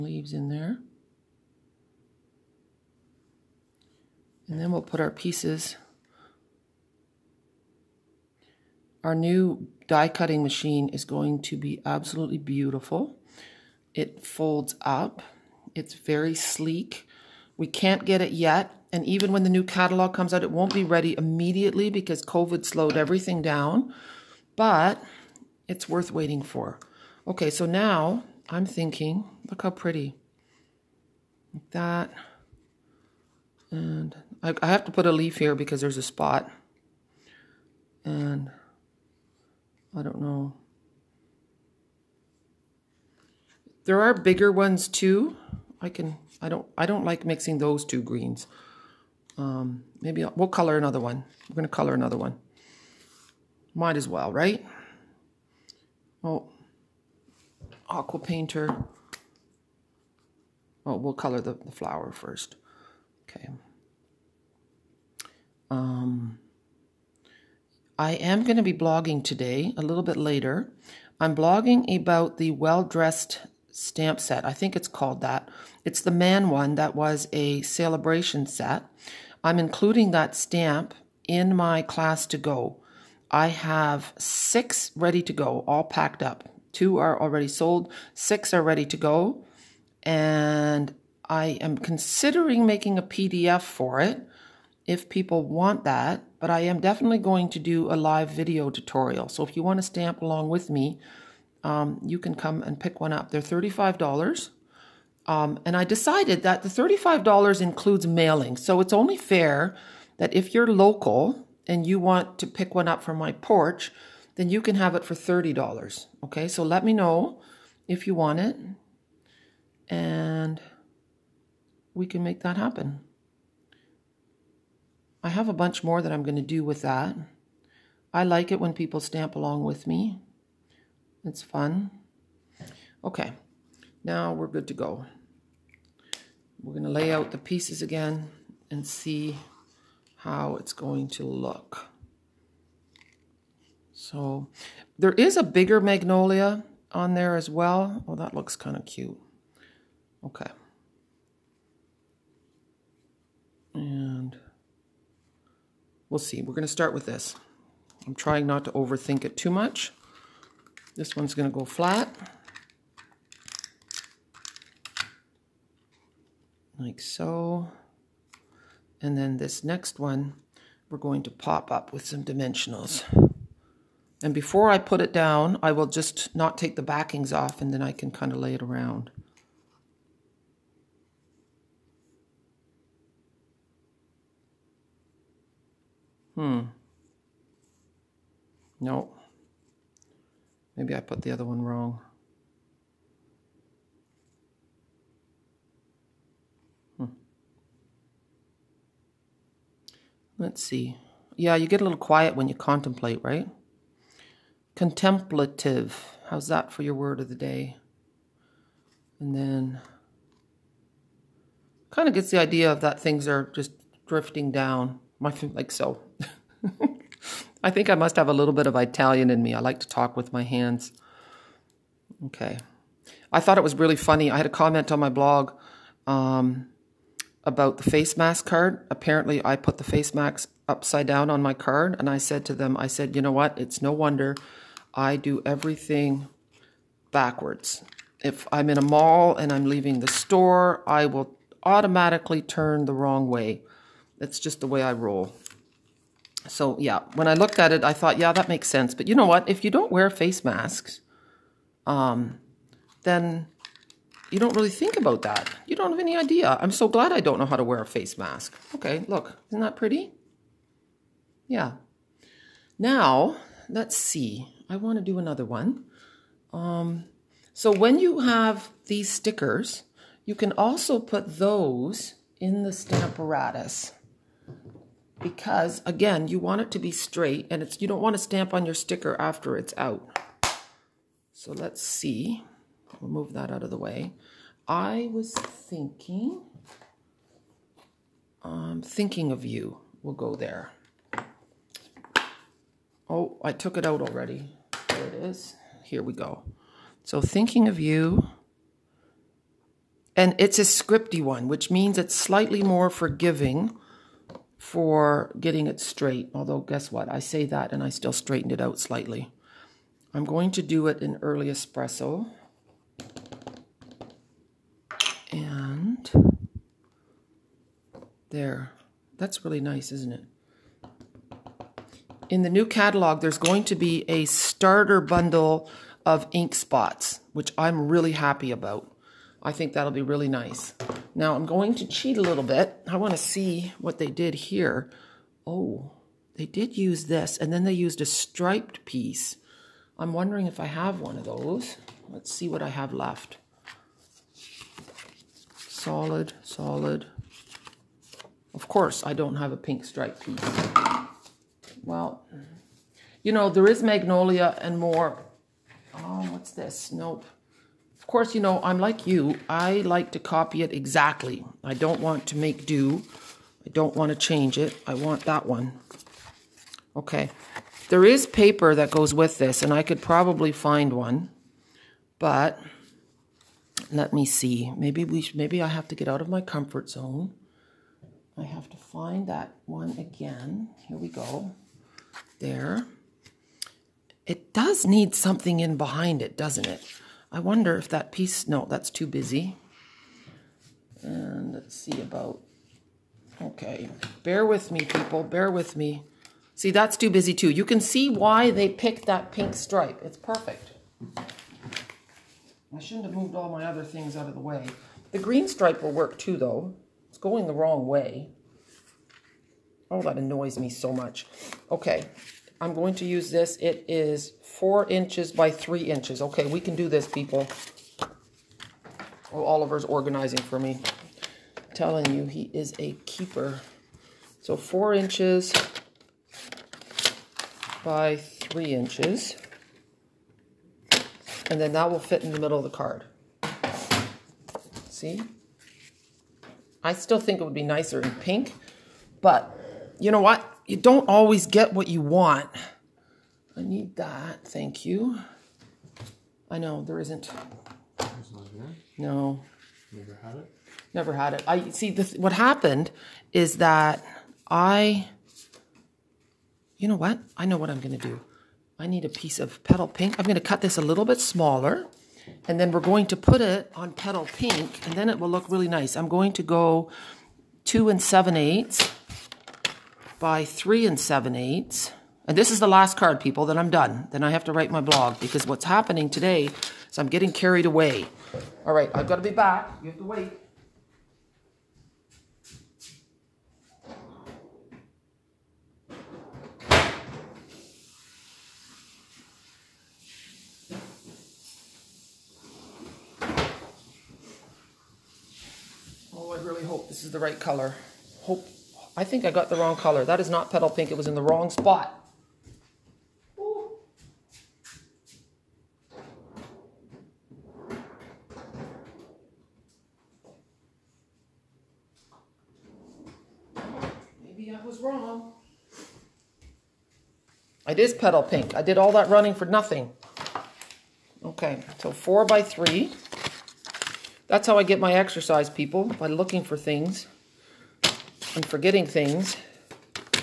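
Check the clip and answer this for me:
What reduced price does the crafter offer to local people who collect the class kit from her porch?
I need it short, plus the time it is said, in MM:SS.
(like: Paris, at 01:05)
$30, at 01:55.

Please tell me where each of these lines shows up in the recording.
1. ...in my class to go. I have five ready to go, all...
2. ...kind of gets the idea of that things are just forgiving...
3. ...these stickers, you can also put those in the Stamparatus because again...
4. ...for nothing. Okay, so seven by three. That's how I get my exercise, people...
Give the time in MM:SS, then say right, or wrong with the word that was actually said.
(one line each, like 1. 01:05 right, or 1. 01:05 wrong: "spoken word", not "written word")
1. 01:21 wrong: "six", not "five"
2. 03:31 wrong: "drifting", not "forgiving"
3. 04:28 right
4. 08:39 wrong: "four", not "seven".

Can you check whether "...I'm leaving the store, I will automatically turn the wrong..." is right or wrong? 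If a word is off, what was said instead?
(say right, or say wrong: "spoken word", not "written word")
right.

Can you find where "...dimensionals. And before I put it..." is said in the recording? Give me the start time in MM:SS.
02:52.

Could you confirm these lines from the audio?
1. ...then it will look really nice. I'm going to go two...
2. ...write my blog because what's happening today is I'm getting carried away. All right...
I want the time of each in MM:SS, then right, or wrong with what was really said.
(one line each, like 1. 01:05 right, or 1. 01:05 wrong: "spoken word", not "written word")
1. 07:44 right
2. 07:54 right.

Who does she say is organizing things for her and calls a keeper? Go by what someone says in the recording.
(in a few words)
Oliver.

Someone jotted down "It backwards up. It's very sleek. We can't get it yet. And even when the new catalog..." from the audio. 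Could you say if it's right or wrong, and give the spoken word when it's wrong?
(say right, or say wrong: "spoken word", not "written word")
wrong: "folds", not "backwards".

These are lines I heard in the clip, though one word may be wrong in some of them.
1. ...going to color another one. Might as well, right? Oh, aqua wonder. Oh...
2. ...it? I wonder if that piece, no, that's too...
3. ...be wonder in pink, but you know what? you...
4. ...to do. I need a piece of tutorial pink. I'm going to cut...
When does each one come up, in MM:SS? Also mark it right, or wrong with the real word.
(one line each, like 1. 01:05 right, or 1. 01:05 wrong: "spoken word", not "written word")
1. 00:51 wrong: "painter", not "wonder"
2. 06:26 right
3. 07:17 wrong: "nicer", not "wonder"
4. 07:37 wrong: "petal", not "tutorial".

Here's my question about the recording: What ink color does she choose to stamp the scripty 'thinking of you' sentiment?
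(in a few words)
Early Espresso.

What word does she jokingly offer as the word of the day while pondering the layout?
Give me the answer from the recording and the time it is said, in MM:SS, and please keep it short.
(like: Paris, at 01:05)
Contemplative, at 03:24.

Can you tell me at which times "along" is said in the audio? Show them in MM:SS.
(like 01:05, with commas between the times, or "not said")
01:40, 02:09.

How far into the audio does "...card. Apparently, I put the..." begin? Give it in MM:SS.
03:48.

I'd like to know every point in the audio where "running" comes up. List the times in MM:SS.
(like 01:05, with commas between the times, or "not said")
08:39.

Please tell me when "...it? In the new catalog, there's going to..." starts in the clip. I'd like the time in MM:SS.
05:20.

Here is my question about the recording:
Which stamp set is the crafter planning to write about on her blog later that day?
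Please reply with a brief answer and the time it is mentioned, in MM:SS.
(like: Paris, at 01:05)
Well Dressed, at 01:12.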